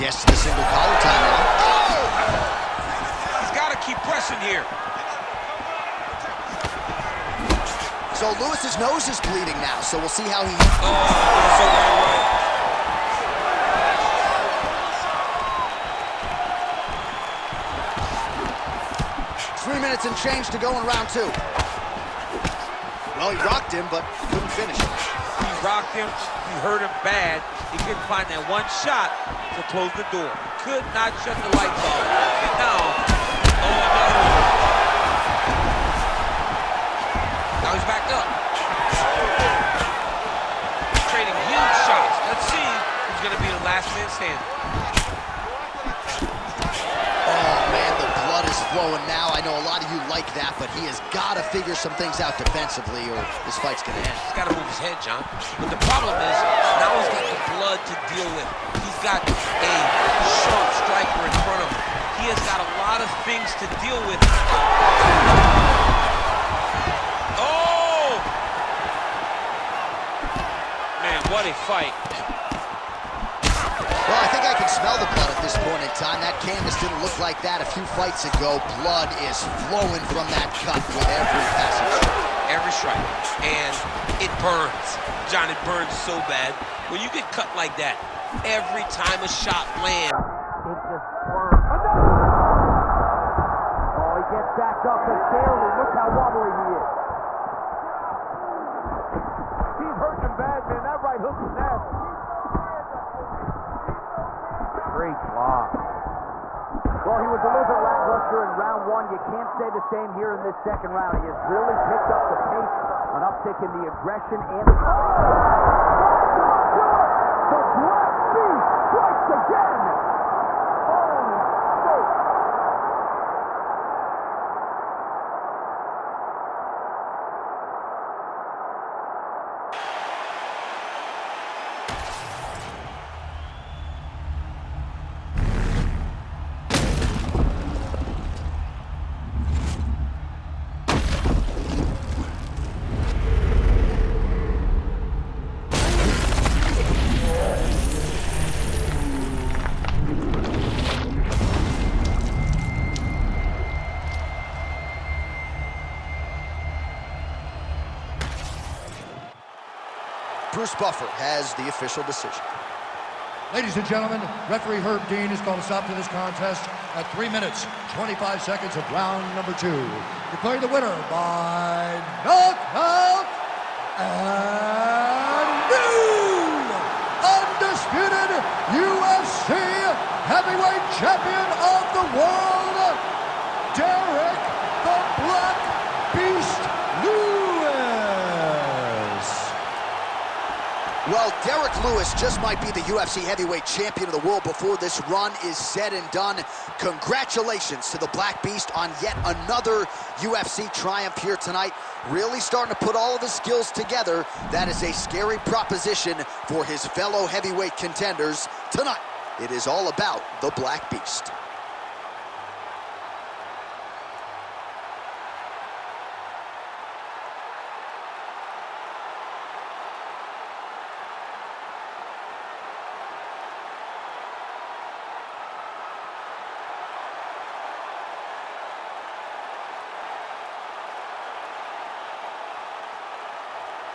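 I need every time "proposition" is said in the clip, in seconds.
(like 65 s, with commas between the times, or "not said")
205 s.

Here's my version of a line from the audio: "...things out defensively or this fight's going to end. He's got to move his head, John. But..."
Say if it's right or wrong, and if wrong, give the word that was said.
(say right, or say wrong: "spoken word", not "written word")
right.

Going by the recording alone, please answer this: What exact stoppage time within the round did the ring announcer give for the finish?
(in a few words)
3 minutes, 25 seconds.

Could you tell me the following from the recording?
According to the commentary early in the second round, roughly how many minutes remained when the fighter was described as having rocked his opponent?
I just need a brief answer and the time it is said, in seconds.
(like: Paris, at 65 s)
3 minutes and change, at 19 s.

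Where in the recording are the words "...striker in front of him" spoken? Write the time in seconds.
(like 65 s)
60 s.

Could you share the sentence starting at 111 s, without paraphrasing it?
He has really picked up the pace, an uptick in the aggression and the...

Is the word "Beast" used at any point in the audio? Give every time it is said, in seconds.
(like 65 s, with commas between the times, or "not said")
118 s, 198 s, 210 s.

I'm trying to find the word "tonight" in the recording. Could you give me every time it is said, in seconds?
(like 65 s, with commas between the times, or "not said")
201 s, 208 s.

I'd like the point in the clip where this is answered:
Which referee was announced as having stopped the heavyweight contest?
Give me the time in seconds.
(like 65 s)
164 s.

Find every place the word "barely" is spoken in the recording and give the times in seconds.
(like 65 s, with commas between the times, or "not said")
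95 s.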